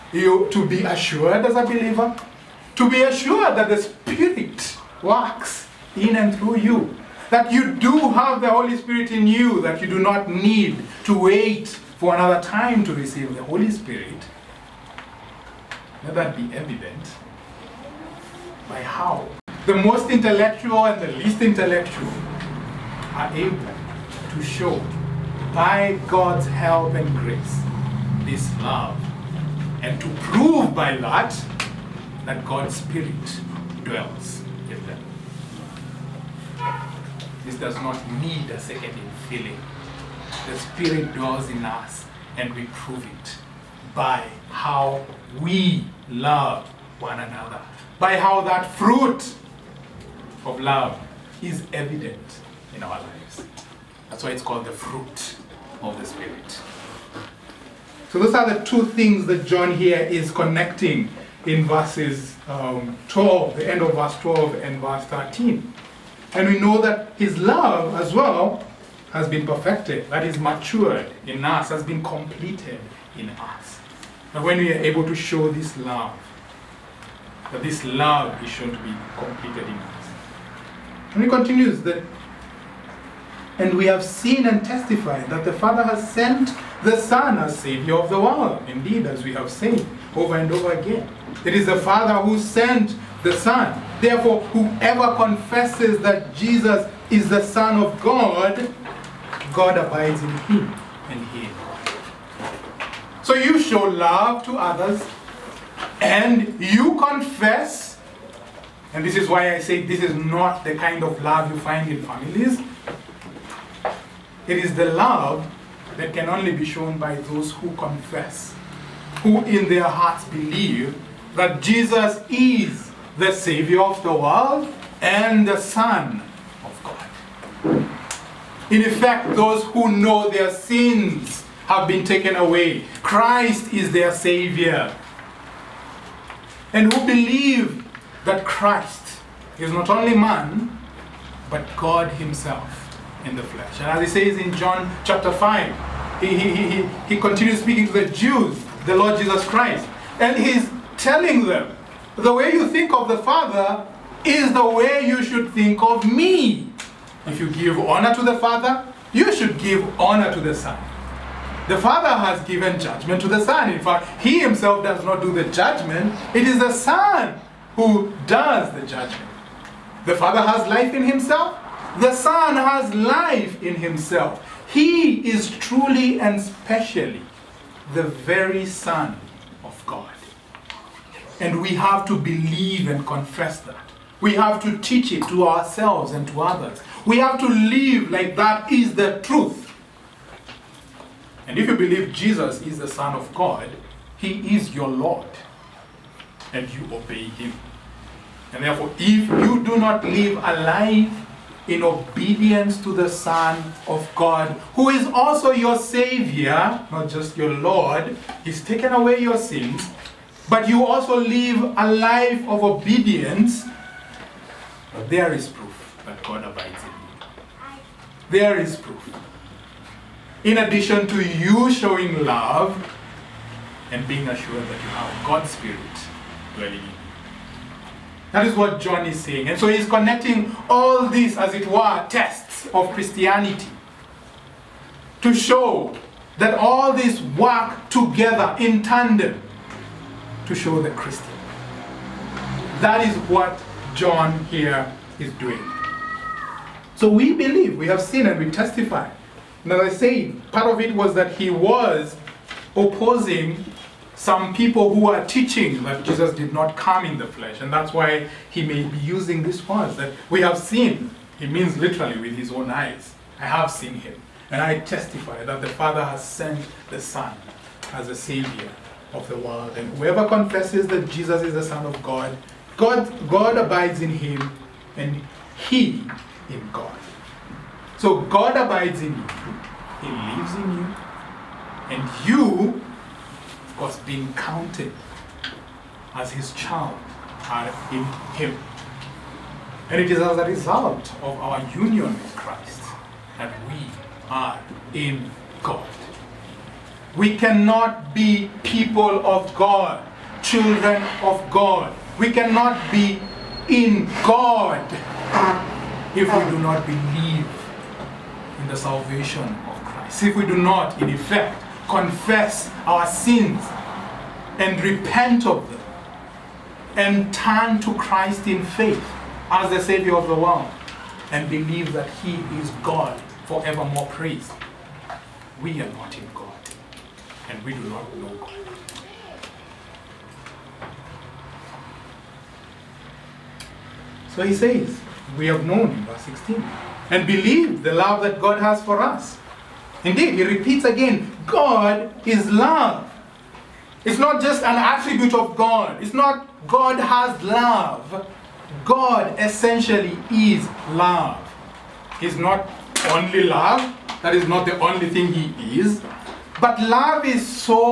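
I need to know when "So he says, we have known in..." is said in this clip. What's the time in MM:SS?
05:34.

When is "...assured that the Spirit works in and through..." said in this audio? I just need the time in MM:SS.
00:03.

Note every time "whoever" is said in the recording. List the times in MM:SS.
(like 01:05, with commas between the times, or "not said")
01:34, 04:29.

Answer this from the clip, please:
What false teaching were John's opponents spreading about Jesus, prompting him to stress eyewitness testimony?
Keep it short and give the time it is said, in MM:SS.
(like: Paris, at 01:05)
Jesus did not come in the flesh, at 04:16.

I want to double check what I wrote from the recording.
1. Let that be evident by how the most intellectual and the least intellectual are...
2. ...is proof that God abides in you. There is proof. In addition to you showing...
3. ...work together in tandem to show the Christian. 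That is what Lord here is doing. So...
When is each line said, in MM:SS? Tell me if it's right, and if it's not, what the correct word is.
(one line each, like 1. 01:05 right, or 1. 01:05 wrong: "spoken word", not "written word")
1. 00:16 right
2. 03:35 right
3. 03:57 wrong: "John", not "Lord".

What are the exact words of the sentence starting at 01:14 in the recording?
But when we are able to show this love, that this love is shown to be completed in us.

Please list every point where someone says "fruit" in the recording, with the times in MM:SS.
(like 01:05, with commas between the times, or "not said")
00:48, 00:54.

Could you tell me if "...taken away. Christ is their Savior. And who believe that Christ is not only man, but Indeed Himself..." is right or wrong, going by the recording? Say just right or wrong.
wrong.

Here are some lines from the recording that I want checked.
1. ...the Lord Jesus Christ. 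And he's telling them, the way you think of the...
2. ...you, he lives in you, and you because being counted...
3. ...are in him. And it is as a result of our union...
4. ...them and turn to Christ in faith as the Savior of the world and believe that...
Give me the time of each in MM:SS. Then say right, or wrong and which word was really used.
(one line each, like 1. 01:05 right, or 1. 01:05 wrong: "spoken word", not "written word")
1. 02:28 right
2. 04:39 right
3. 04:47 right
4. 05:15 right.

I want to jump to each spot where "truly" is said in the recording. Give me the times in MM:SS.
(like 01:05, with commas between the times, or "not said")
02:55.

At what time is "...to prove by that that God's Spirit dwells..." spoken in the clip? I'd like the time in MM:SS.
00:29.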